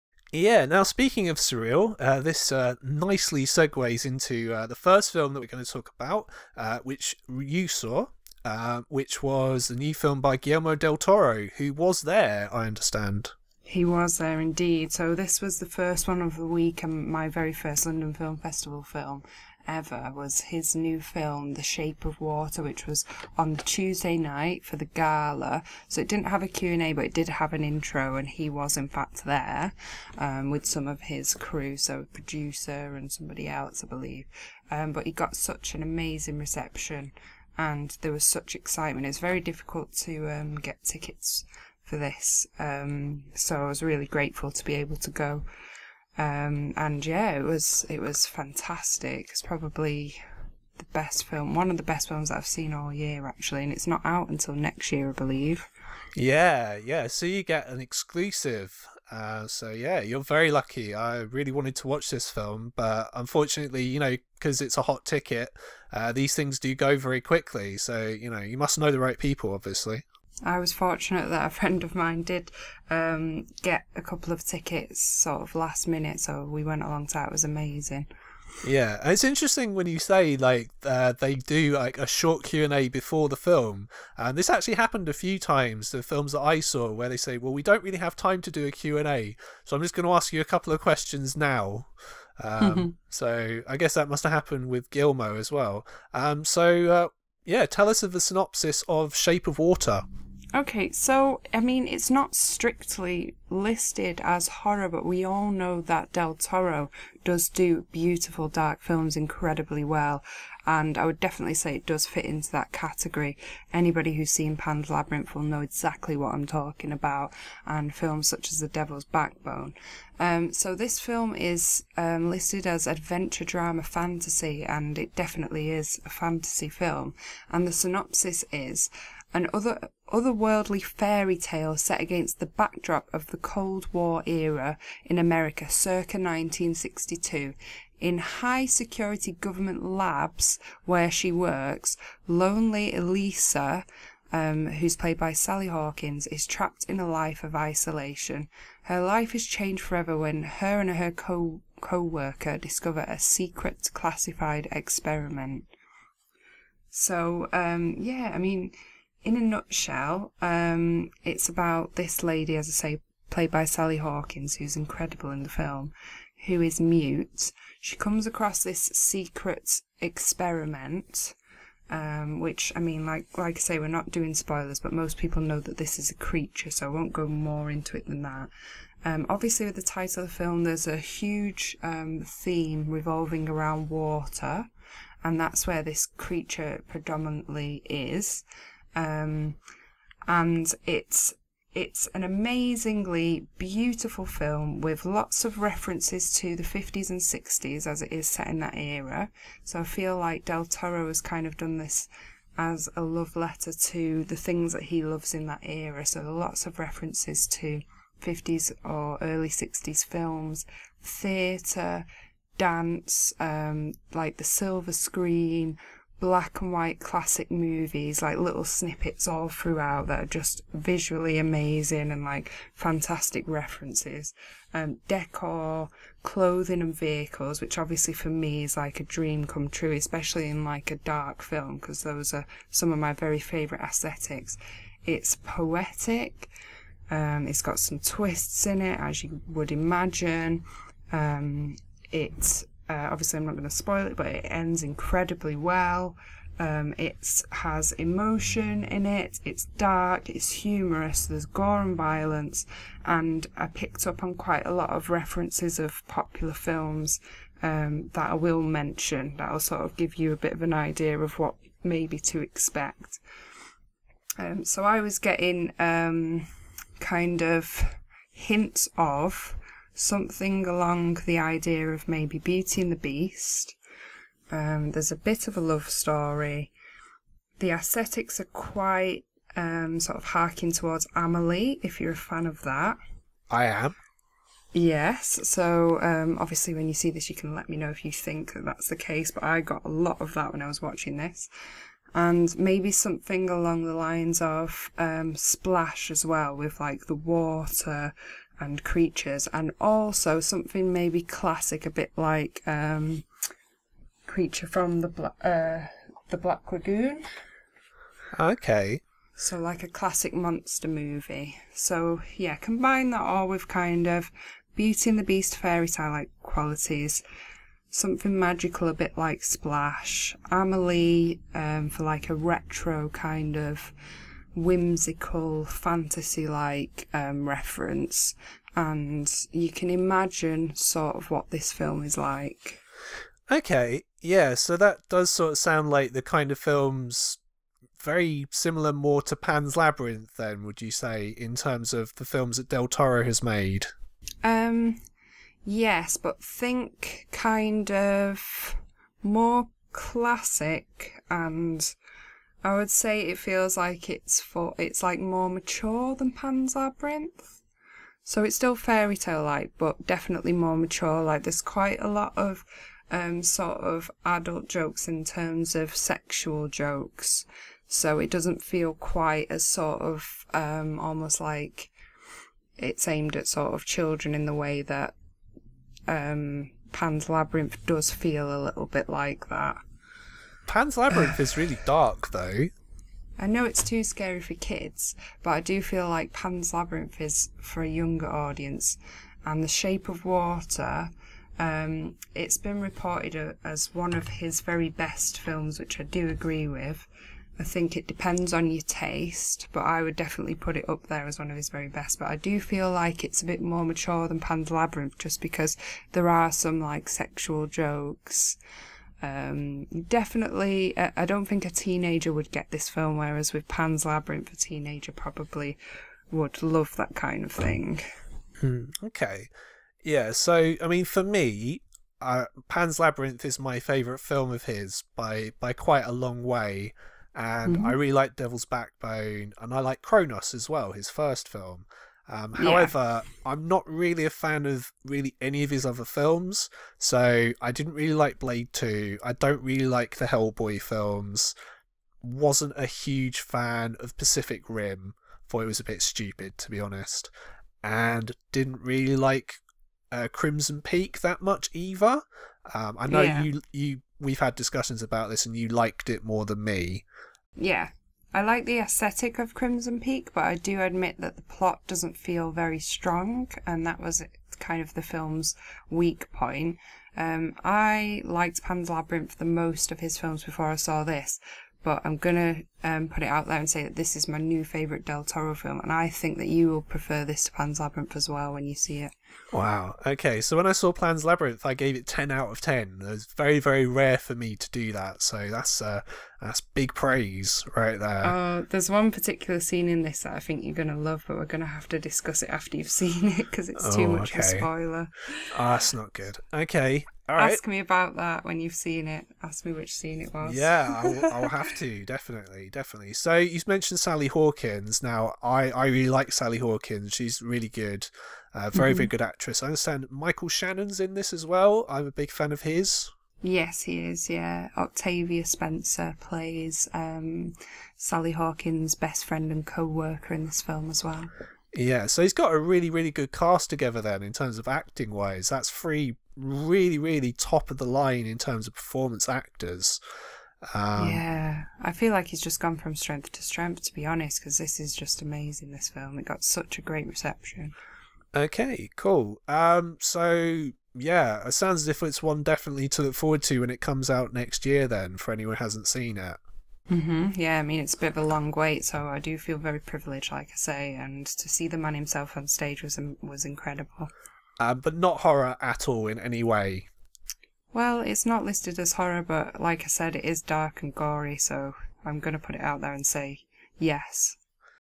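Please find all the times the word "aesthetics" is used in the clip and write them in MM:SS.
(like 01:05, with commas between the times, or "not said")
03:53, 04:37, 07:38.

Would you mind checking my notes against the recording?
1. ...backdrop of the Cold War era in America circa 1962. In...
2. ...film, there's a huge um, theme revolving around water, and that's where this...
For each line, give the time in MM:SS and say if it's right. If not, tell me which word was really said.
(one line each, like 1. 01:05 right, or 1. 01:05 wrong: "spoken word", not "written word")
1. 02:12 right
2. 03:00 right.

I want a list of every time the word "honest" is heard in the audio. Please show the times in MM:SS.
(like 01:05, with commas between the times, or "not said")
07:26, 08:54.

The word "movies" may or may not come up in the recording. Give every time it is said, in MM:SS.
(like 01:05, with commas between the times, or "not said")
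03:37, 05:10.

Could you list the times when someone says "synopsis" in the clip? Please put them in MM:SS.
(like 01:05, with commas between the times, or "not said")
01:38, 02:07.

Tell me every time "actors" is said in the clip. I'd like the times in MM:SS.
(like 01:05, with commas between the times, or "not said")
08:49.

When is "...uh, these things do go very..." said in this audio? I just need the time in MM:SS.
01:05.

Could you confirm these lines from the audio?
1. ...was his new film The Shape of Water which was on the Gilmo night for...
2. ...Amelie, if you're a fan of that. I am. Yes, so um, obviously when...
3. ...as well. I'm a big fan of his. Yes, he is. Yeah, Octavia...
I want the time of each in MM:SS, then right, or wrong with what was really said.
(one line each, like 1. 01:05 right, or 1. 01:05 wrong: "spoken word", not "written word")
1. 00:20 wrong: "Tuesday", not "Gilmo"
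2. 04:41 right
3. 08:31 right.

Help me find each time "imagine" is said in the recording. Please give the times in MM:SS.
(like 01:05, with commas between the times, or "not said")
03:59, 05:29.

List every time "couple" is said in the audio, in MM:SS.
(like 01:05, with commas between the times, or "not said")
01:14, 01:30.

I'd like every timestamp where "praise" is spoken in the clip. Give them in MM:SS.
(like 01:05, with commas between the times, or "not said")
08:06.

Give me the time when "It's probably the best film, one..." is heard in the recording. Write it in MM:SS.
00:49.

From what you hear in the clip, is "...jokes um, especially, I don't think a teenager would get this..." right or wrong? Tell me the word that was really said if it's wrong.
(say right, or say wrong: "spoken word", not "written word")
wrong: "definitely", not "especially".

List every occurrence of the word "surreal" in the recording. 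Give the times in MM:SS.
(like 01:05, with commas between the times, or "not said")
00:01.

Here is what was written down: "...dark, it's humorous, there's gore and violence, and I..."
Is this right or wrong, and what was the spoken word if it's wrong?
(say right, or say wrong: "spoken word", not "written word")
right.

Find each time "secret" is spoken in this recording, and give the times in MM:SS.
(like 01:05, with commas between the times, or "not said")
02:33, 02:48.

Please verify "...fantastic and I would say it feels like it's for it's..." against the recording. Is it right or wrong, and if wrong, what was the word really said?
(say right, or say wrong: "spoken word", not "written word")
wrong: "classic", not "fantastic".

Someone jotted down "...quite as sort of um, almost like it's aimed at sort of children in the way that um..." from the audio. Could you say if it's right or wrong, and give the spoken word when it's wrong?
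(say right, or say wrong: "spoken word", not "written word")
right.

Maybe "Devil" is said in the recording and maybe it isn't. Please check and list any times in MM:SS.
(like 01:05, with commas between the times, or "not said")
01:58, 07:08.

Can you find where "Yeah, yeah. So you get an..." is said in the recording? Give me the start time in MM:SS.
00:56.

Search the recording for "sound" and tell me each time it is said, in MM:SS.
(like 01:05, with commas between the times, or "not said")
05:35, 09:01.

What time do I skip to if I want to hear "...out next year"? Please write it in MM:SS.
09:04.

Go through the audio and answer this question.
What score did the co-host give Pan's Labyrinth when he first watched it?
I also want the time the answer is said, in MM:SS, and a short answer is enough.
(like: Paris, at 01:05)
10 out of 10, at 08:02.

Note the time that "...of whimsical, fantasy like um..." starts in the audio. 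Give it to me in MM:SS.
05:23.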